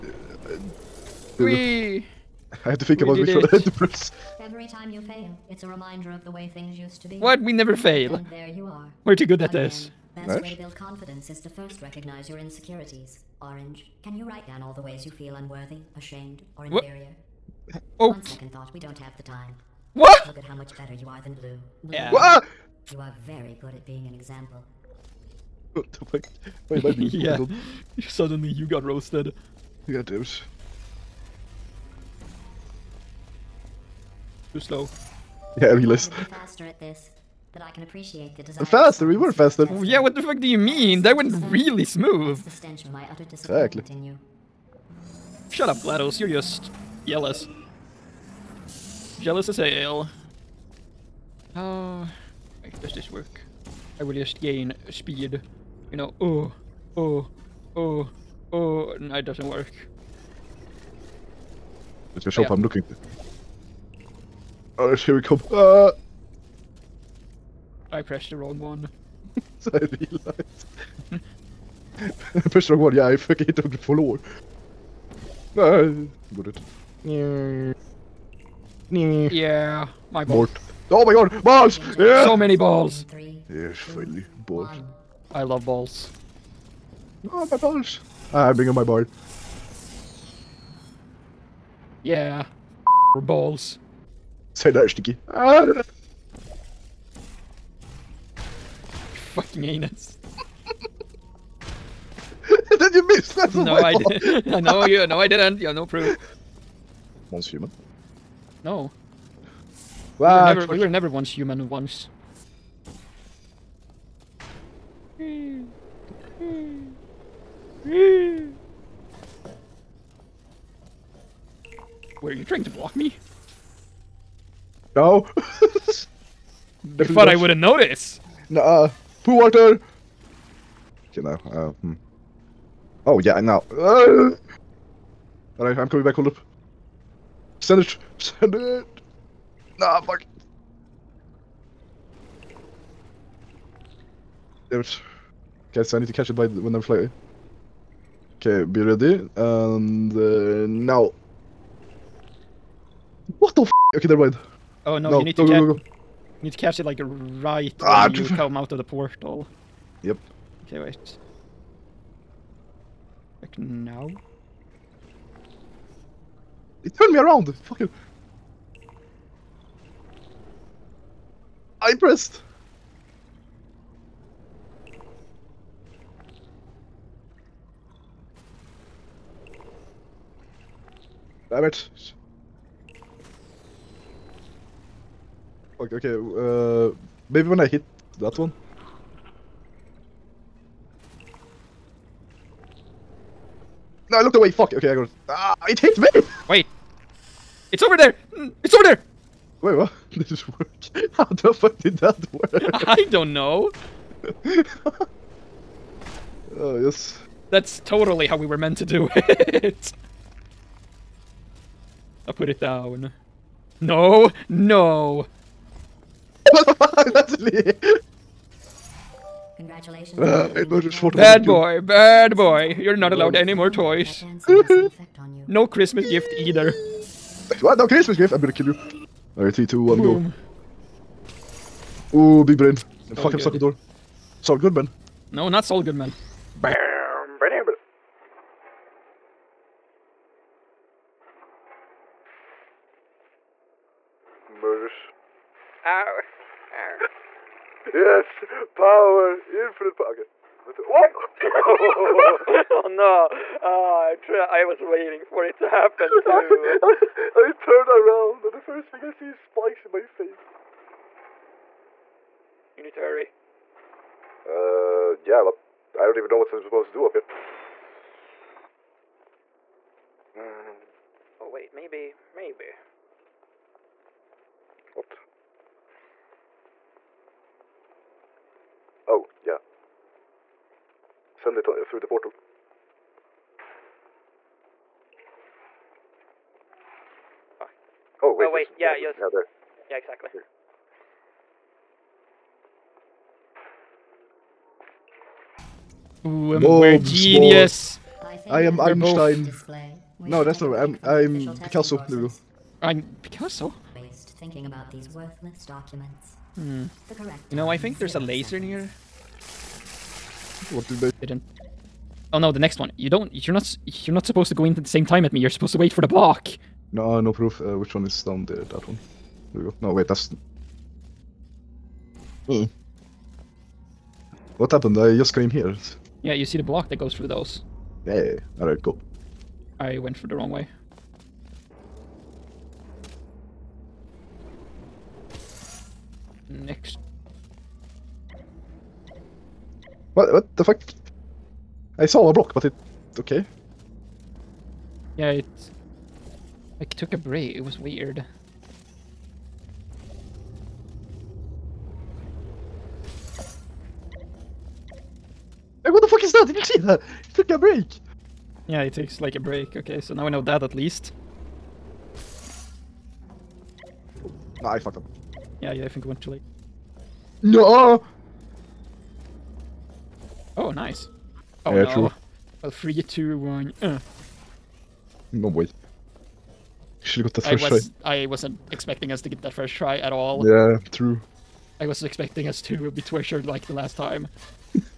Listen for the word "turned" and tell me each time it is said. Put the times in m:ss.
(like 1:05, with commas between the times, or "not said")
2:46, 4:17.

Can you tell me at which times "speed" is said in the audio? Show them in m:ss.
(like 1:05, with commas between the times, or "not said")
0:54.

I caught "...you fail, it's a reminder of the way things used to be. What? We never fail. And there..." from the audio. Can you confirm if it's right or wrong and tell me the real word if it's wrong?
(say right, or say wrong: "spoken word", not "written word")
right.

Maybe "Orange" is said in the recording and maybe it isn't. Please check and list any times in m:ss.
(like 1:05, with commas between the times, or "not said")
0:13.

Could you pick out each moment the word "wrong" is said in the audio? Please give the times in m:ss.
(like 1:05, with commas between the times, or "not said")
1:08, 1:12, 5:30.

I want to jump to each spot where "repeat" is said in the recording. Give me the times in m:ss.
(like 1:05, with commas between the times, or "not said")
not said.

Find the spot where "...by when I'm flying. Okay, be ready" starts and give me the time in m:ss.
2:26.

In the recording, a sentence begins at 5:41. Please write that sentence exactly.
I saw a block, but it...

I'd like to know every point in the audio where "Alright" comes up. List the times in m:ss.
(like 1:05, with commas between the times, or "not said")
3:49, 5:28.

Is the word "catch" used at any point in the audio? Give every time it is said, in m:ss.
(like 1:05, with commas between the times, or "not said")
2:26, 2:36.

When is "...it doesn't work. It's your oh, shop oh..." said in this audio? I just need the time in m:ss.
0:59.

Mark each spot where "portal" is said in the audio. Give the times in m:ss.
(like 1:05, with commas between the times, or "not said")
2:38, 4:42.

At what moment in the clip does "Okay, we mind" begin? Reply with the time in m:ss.
2:33.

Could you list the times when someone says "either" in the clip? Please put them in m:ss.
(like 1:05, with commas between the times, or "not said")
3:46.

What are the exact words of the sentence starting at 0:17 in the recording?
Oh, On second thought, we don't have the time.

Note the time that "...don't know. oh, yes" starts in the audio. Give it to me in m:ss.
3:23.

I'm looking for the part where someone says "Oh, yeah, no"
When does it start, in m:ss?
6:11.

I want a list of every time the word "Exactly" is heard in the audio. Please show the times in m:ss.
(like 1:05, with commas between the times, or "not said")
0:43, 4:49.